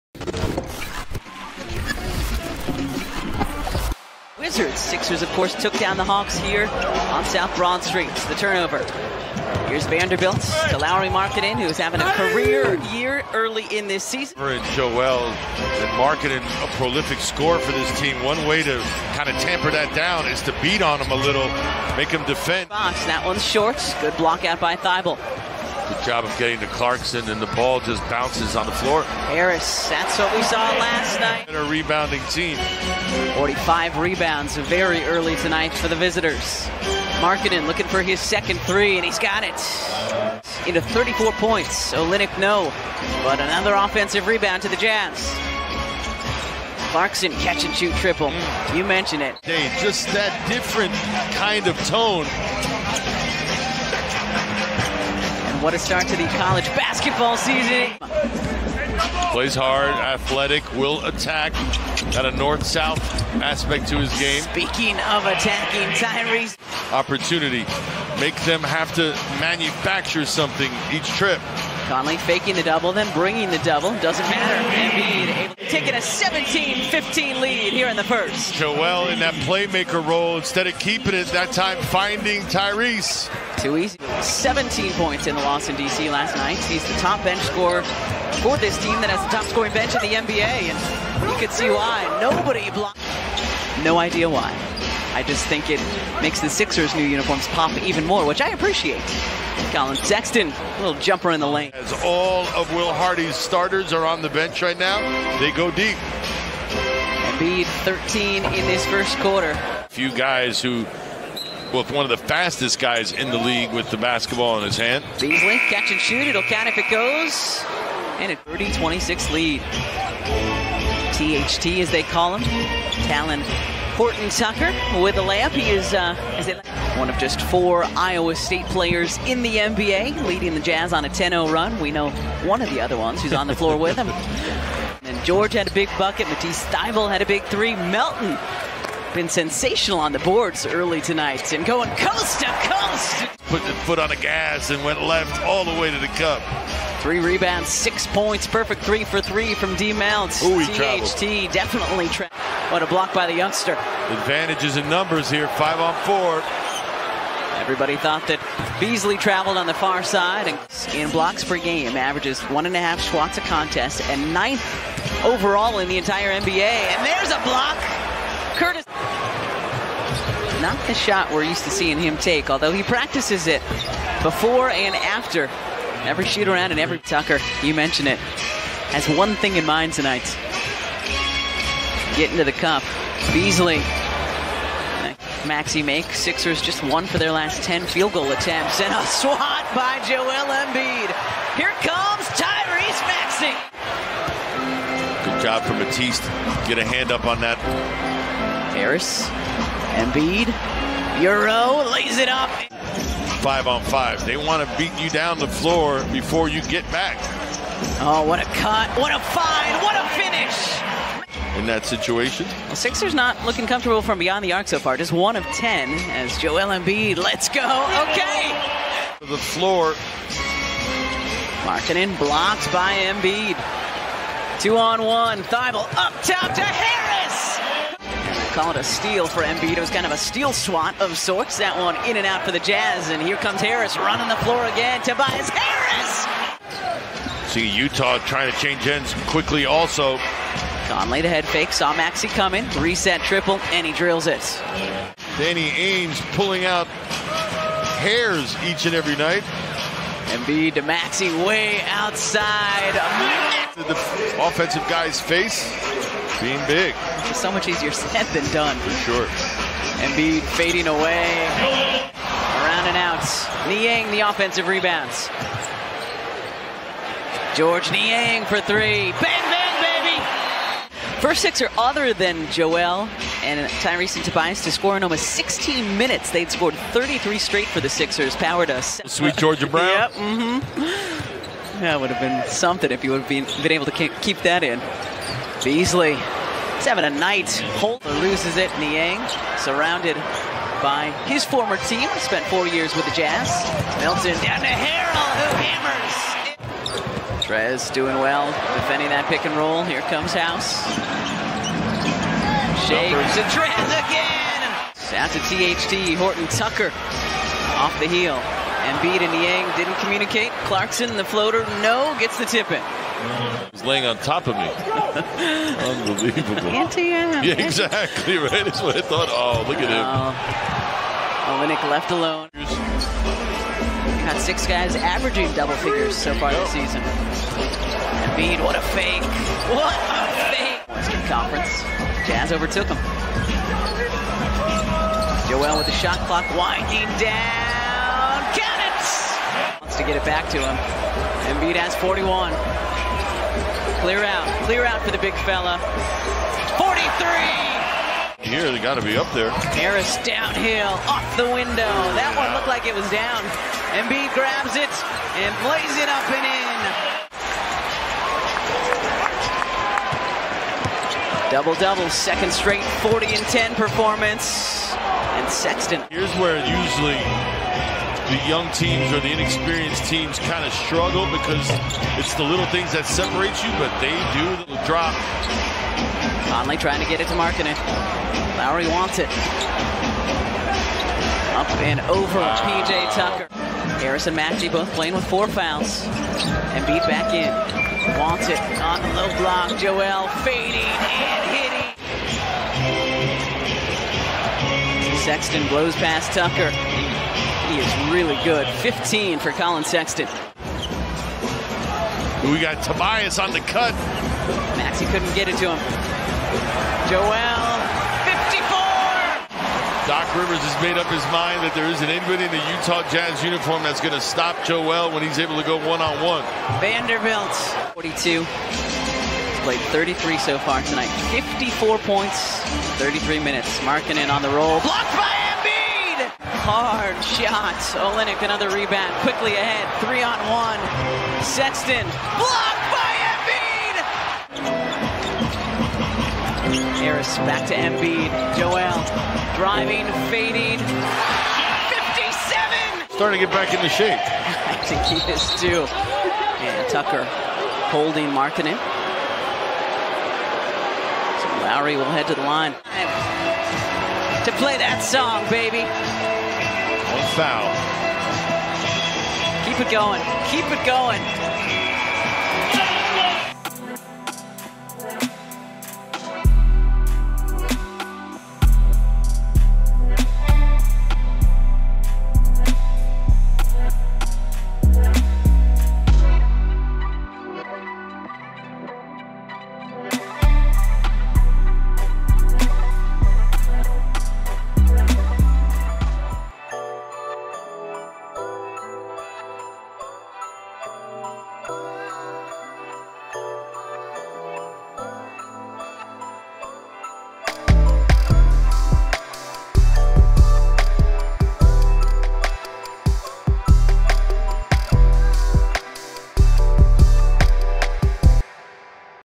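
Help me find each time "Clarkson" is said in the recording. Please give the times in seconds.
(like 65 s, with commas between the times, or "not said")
26 s, 46 s, 310 s.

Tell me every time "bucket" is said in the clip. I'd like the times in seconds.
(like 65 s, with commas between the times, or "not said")
135 s.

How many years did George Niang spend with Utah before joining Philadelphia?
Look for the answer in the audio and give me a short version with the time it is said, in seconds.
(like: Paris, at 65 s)
four years, at 292 s.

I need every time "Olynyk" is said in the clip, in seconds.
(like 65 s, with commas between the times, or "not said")
41 s, 428 s.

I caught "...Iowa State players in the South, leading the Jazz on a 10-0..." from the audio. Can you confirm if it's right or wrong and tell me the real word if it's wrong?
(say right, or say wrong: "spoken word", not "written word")
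wrong: "NBA", not "South".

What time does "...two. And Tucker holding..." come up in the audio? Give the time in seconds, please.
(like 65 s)
445 s.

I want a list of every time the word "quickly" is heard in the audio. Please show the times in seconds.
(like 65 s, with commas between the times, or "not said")
239 s, 429 s.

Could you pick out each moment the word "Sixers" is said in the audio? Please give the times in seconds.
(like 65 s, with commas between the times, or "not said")
4 s, 96 s, 186 s, 212 s, 277 s.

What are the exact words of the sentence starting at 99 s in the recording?
Collin Sexton, little jumper in the lane.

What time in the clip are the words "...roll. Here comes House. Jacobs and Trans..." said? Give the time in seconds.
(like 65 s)
299 s.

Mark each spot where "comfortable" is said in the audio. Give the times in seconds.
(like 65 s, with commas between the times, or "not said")
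213 s.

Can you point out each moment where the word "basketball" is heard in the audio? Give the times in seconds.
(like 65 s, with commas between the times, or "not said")
56 s, 113 s.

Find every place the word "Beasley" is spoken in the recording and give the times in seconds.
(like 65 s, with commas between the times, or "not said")
115 s, 158 s, 183 s, 285 s.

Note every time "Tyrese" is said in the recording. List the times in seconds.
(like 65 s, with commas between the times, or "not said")
65 s, 82 s, 192 s, 273 s.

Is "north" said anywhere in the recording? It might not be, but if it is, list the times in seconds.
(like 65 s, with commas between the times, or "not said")
62 s.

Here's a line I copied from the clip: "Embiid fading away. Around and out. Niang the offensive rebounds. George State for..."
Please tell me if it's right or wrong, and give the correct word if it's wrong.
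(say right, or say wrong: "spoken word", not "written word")
wrong: "Niang", not "State".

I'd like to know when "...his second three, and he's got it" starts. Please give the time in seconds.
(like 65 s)
38 s.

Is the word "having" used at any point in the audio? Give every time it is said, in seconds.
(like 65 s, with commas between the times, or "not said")
11 s, 286 s.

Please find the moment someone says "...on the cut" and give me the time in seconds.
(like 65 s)
403 s.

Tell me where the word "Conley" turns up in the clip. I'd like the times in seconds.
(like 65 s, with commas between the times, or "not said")
71 s, 240 s, 376 s.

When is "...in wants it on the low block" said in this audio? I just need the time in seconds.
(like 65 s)
387 s.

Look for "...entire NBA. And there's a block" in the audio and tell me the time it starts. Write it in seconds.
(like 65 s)
165 s.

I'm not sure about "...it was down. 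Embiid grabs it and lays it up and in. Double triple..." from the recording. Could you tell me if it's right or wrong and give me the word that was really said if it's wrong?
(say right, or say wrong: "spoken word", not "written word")
wrong: "double", not "triple".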